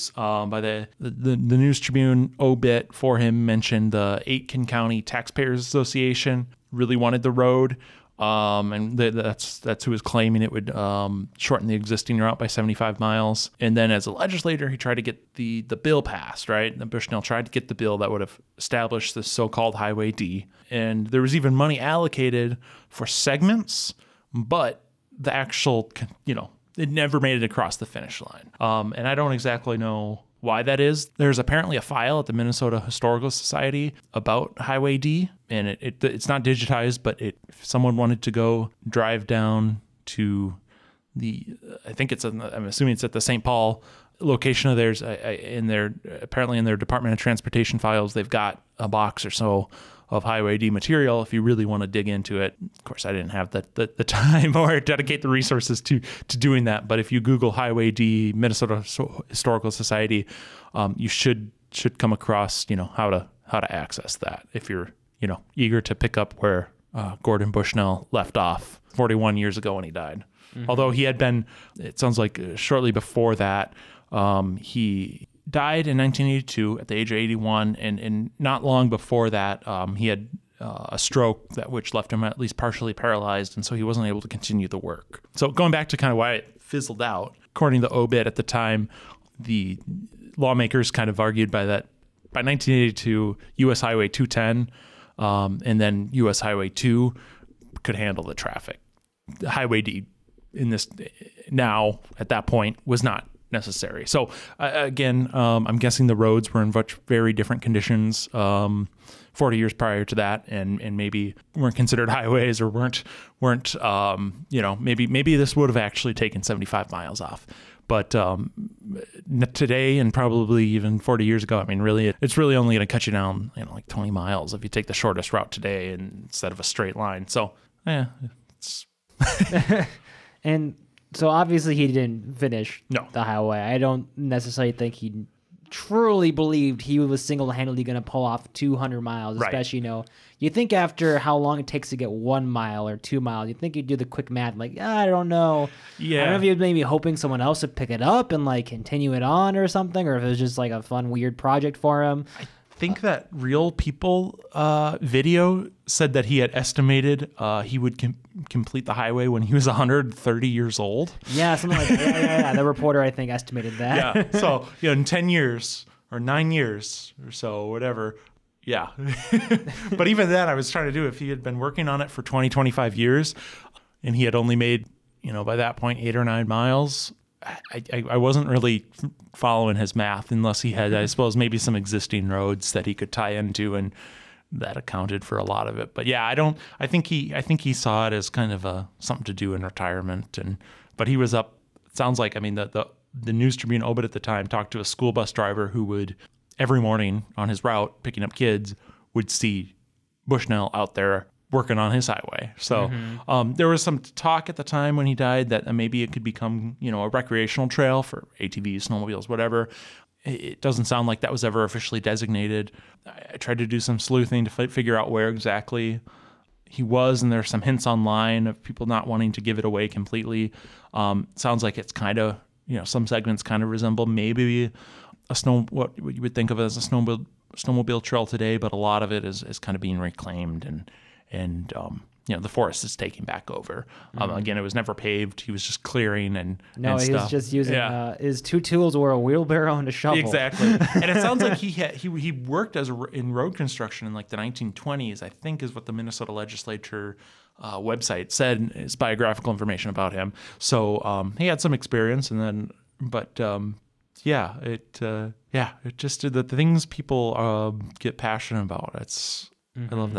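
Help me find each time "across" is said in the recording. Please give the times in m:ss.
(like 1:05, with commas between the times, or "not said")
0:27, 1:02.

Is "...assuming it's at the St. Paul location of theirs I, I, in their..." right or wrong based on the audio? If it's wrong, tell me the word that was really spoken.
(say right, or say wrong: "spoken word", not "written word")
right.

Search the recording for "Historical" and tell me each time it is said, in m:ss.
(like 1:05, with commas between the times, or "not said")
0:32, 0:59.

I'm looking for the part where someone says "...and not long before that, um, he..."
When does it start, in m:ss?
1:17.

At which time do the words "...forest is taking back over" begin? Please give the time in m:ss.
3:52.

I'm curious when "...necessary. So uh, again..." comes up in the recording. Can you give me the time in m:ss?
1:43.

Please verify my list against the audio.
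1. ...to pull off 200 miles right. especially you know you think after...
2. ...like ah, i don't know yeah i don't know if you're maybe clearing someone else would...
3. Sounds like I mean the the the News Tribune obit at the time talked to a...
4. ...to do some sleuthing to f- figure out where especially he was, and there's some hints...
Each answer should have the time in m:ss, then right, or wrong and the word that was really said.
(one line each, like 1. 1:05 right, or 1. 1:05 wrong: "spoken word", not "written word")
1. 2:17 right
2. 2:24 wrong: "hoping", not "clearing"
3. 3:11 right
4. 3:33 wrong: "exactly", not "especially".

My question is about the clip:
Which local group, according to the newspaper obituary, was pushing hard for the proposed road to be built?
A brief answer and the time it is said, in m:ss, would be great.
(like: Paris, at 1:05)
Aitken County Taxpayers Association, at 0:04.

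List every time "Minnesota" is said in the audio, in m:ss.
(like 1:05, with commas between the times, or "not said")
0:32, 0:58, 4:05.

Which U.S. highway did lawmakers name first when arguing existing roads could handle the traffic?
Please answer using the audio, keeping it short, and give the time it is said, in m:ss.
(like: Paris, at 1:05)
U.S. Highway 210, at 1:33.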